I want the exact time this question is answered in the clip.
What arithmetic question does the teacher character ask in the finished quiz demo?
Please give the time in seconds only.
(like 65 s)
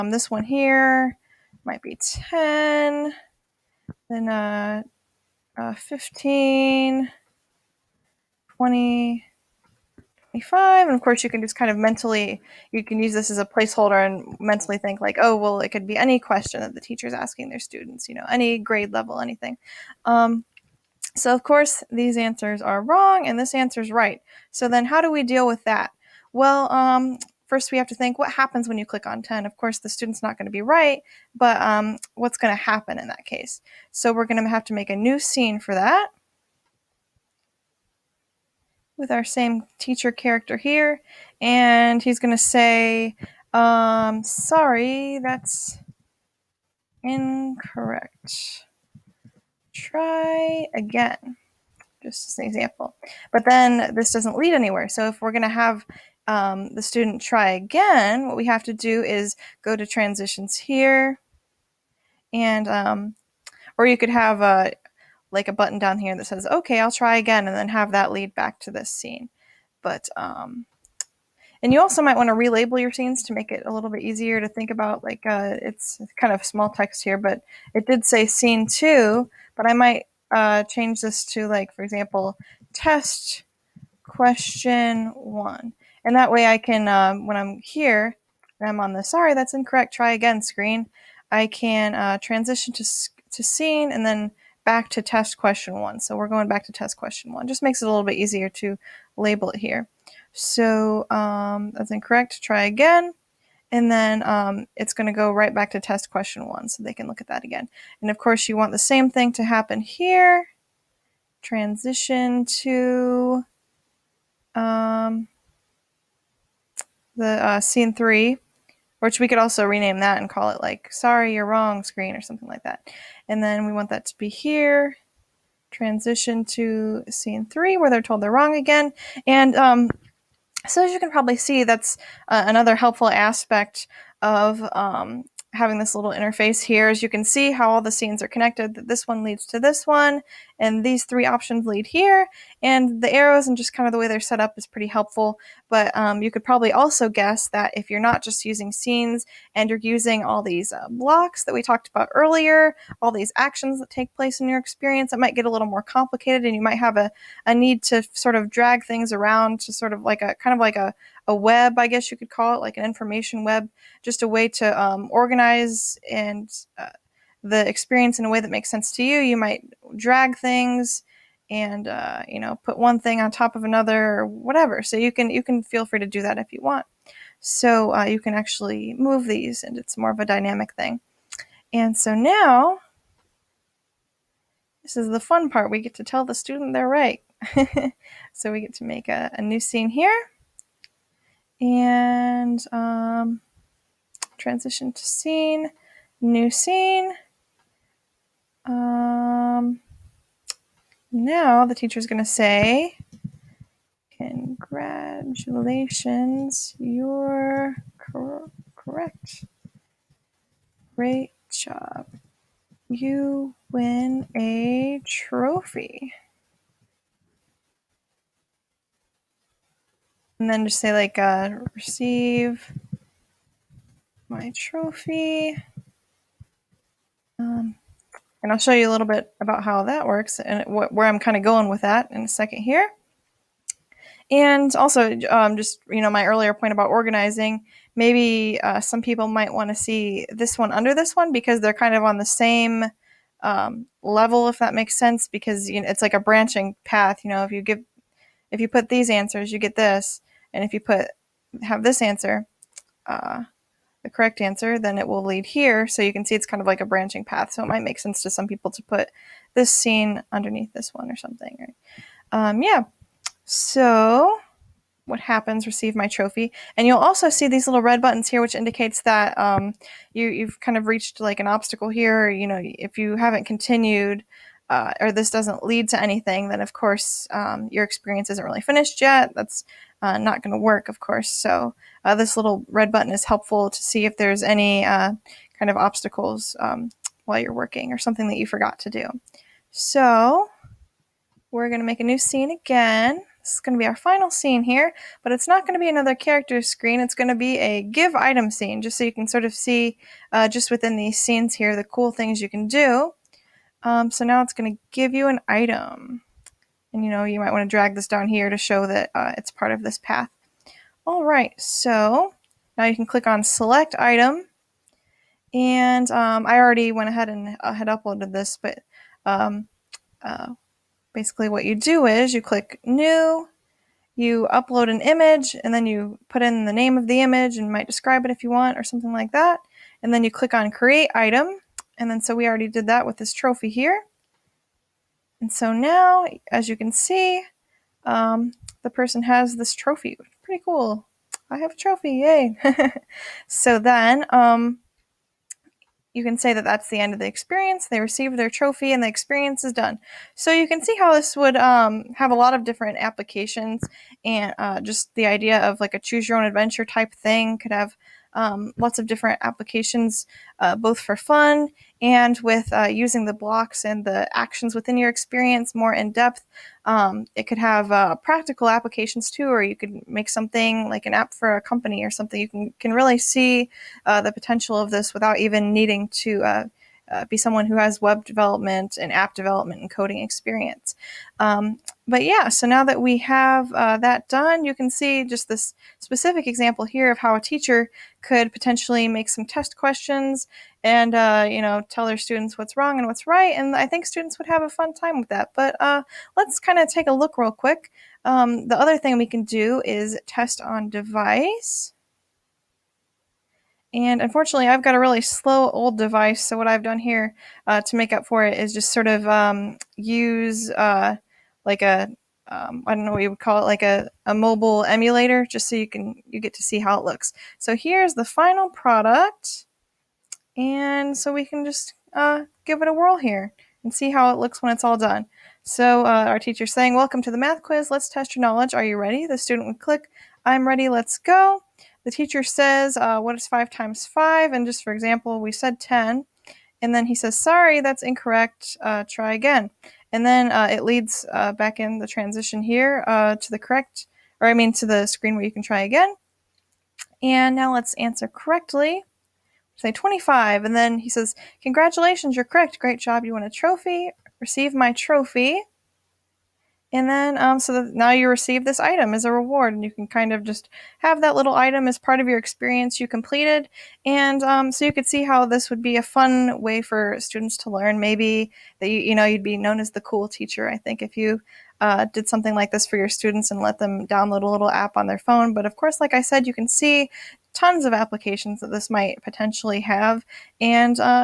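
433 s.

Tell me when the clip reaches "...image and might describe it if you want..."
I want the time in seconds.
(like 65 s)
327 s.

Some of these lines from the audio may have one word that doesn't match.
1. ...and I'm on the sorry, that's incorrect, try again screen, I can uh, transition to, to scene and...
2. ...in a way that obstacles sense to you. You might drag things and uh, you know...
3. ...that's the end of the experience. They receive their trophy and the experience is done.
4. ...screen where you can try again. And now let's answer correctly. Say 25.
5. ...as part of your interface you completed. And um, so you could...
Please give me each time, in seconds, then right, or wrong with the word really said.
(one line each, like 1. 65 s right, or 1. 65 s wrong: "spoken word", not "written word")
1. 88 s right
2. 168 s wrong: "makes", not "obstacles"
3. 346 s right
4. 445 s right
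5. 461 s wrong: "experience", not "interface".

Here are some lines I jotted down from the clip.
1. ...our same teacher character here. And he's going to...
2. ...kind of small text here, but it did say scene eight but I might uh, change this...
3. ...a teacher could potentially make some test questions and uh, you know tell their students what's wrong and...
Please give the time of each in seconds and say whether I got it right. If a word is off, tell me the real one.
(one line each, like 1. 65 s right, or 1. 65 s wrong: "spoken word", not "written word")
1. 39 s right
2. 76 s wrong: "two", not "eight"
3. 387 s right.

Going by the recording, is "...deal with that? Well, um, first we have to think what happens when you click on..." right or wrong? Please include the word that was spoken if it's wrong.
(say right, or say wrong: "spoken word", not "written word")
right.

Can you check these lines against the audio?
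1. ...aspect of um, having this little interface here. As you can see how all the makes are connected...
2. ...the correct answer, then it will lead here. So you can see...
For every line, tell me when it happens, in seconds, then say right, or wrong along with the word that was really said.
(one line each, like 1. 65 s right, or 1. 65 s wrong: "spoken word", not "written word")
1. 133 s wrong: "scenes", not "makes"
2. 254 s right.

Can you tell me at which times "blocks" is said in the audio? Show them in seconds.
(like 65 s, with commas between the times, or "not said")
150 s, 363 s.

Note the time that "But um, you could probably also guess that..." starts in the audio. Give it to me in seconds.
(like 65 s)
145 s.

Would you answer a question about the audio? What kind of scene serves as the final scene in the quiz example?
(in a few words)
give item scene.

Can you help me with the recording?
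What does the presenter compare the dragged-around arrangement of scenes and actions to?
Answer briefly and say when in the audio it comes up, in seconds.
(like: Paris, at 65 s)
information web, at 162 s.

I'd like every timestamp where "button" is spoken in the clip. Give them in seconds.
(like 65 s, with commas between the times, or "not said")
65 s, 268 s, 282 s.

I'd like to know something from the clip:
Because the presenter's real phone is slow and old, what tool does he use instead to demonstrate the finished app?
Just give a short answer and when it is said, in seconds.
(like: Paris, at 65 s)
mobile emulator, at 414 s.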